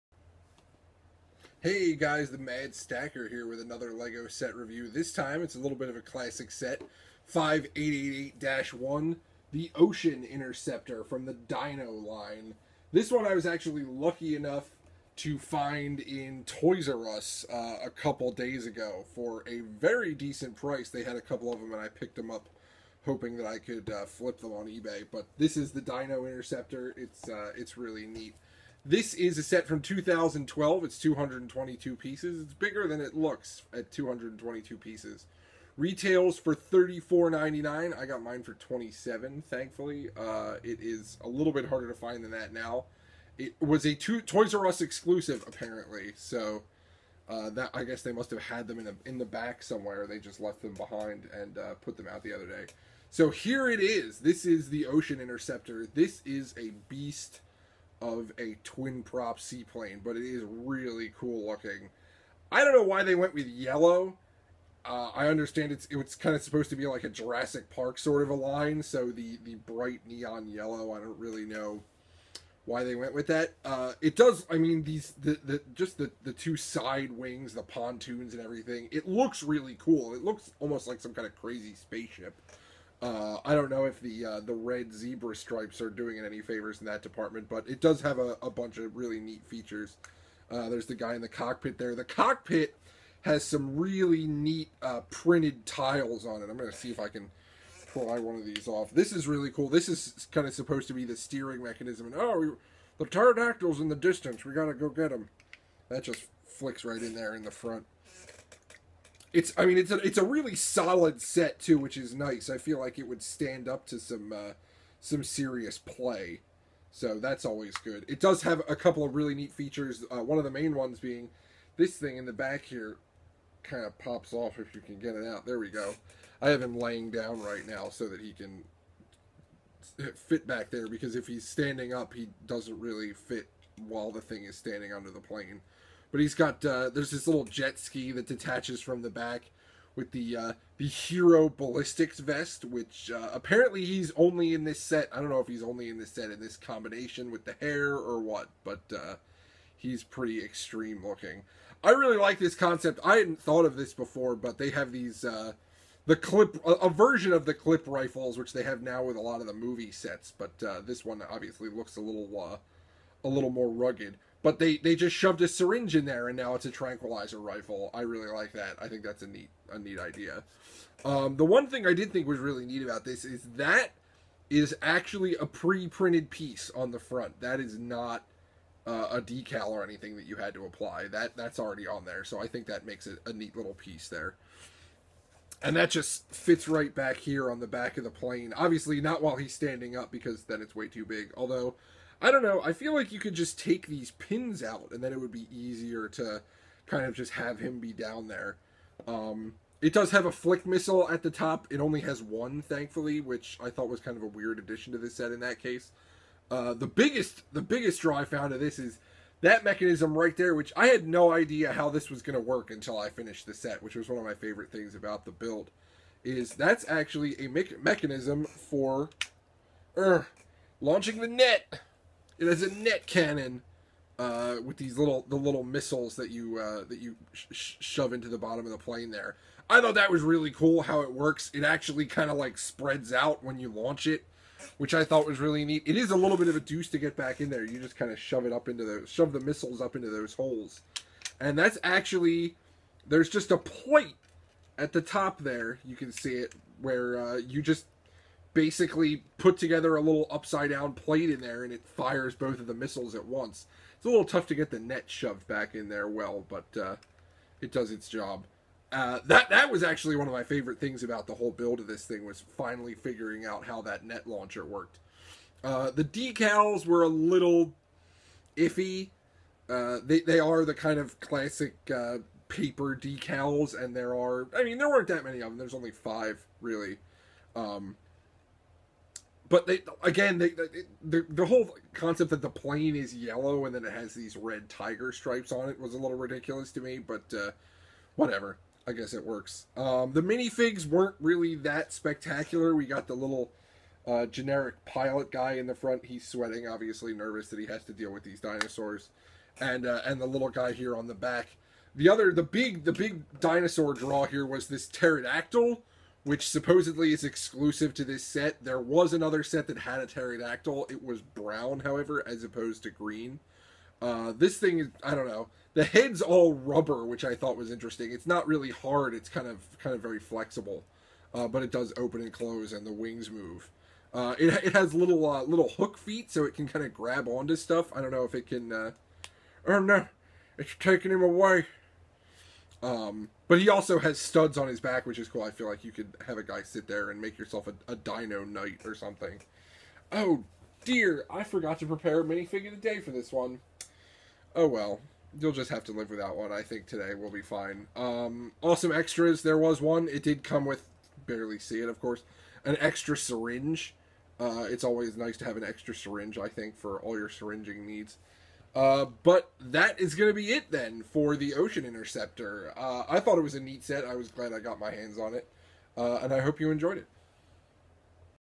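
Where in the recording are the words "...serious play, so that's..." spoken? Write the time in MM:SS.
01:55.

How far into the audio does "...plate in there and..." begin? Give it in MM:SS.
04:10.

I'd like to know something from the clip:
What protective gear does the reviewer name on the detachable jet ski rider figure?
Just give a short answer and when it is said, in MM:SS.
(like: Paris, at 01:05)
hero ballistics vest, at 02:20.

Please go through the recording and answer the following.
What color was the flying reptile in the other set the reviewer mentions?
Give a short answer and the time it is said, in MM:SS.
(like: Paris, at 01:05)
brown, at 05:11.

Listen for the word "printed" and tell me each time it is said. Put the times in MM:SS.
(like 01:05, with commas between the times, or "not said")
01:35, 02:55.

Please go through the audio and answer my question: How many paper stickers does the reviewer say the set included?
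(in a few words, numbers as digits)
5.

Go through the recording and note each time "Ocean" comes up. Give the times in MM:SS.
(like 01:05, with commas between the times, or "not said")
00:09, 00:54, 06:01.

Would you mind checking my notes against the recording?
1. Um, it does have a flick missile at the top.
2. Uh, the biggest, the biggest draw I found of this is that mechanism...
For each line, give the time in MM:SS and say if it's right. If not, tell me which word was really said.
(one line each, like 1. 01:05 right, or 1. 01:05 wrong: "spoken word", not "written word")
1. 03:19 right
2. 03:26 right.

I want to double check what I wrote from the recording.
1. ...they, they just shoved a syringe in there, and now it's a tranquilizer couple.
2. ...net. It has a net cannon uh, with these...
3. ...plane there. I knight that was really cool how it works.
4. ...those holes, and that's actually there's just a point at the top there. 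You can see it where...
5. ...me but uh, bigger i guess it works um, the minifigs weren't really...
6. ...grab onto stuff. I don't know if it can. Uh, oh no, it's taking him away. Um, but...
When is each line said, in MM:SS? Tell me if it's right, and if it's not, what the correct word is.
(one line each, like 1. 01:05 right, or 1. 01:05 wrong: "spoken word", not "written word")
1. 02:44 wrong: "rifle", not "couple"
2. 03:41 right
3. 03:48 wrong: "thought", not "knight"
4. 04:00 right
5. 04:46 wrong: "whatever", not "bigger"
6. 05:26 right.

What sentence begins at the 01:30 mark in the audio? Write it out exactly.
Uh, there's the guy in the cockpit there.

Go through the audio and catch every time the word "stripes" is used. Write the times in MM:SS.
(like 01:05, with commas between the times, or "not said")
01:25, 04:45.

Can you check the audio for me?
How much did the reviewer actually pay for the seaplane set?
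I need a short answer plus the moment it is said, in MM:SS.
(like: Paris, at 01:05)
27, at 00:38.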